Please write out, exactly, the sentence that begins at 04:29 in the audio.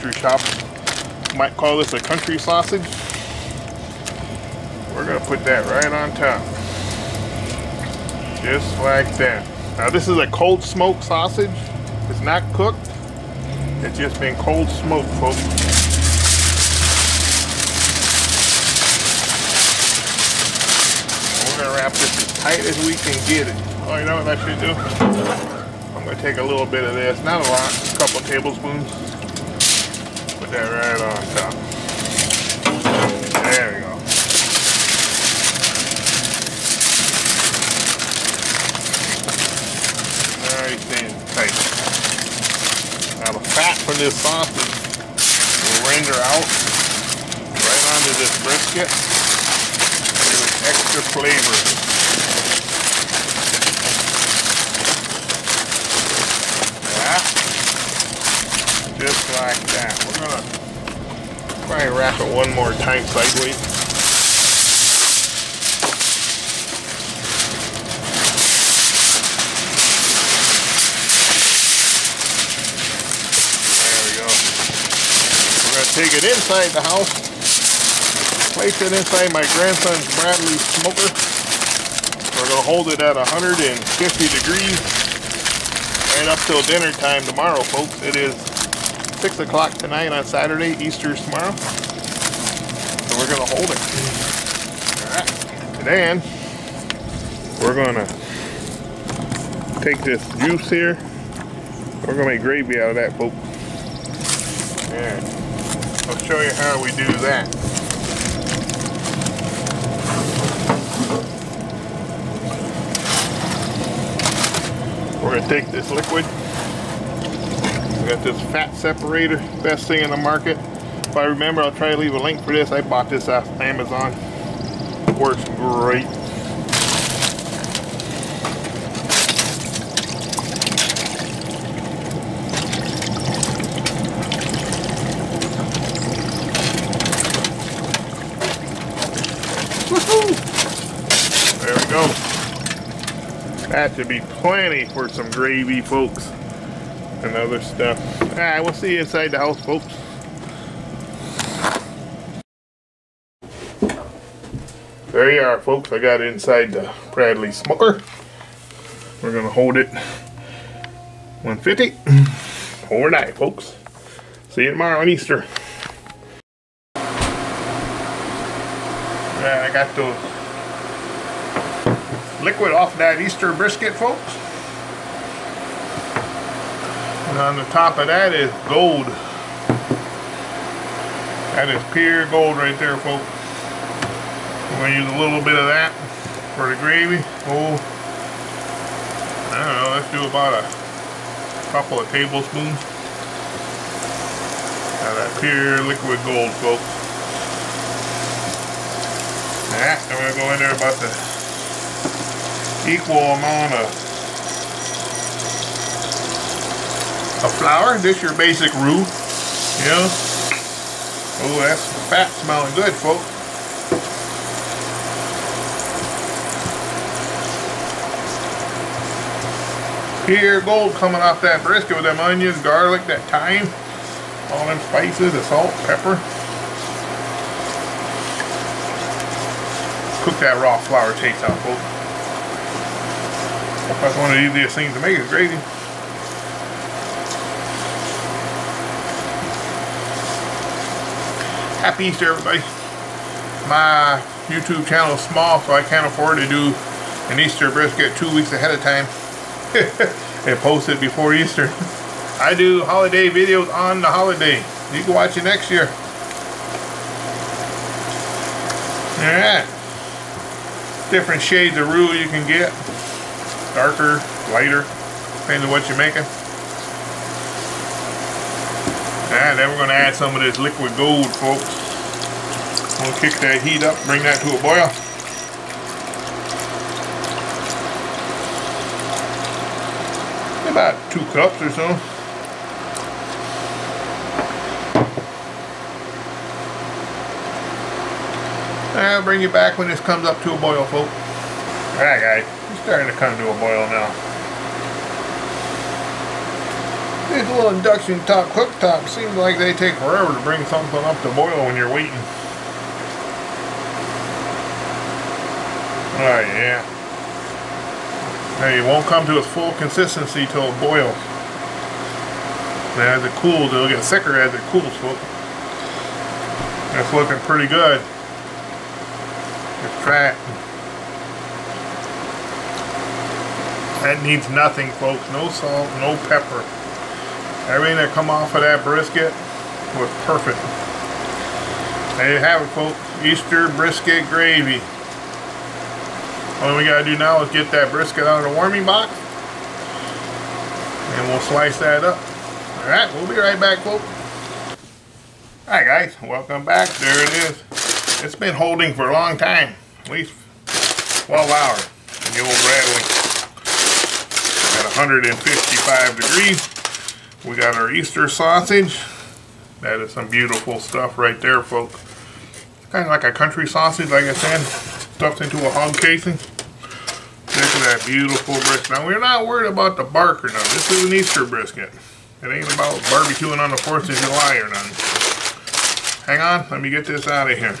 Now we're going to add some of this liquid gold, folks.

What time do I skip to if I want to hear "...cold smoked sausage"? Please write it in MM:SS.
00:10.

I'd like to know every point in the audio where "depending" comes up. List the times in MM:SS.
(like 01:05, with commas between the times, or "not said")
04:25.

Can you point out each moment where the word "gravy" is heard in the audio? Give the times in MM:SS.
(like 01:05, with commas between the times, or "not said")
01:42, 02:25, 03:06, 03:55, 05:34.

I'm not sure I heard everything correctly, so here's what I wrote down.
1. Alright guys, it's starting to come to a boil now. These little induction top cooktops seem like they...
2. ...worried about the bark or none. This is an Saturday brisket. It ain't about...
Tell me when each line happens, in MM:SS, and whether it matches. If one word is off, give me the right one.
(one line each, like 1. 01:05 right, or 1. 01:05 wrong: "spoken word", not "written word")
1. 04:51 right
2. 06:09 wrong: "Easter", not "Saturday".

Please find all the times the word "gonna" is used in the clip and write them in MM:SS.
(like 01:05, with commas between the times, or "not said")
00:05, 00:26.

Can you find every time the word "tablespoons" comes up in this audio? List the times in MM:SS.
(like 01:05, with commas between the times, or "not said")
00:28, 03:12.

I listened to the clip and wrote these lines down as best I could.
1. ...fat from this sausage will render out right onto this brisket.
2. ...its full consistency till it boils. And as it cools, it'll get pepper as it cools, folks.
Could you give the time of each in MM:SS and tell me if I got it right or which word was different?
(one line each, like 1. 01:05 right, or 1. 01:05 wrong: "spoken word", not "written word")
1. 00:43 right
2. 05:09 wrong: "thicker", not "pepper".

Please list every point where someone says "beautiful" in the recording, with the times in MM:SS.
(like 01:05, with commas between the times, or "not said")
06:00, 06:08.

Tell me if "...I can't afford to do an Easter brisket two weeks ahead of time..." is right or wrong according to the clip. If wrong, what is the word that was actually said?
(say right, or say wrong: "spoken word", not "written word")
right.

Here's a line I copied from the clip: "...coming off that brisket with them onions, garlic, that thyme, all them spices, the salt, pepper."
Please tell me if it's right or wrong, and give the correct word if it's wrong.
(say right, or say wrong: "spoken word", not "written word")
right.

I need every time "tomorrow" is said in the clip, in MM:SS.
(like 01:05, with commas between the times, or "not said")
01:31, 02:44.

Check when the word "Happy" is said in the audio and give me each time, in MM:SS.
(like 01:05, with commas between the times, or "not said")
04:01.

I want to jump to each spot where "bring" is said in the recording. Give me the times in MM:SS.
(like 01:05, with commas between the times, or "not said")
04:34, 04:49, 05:00.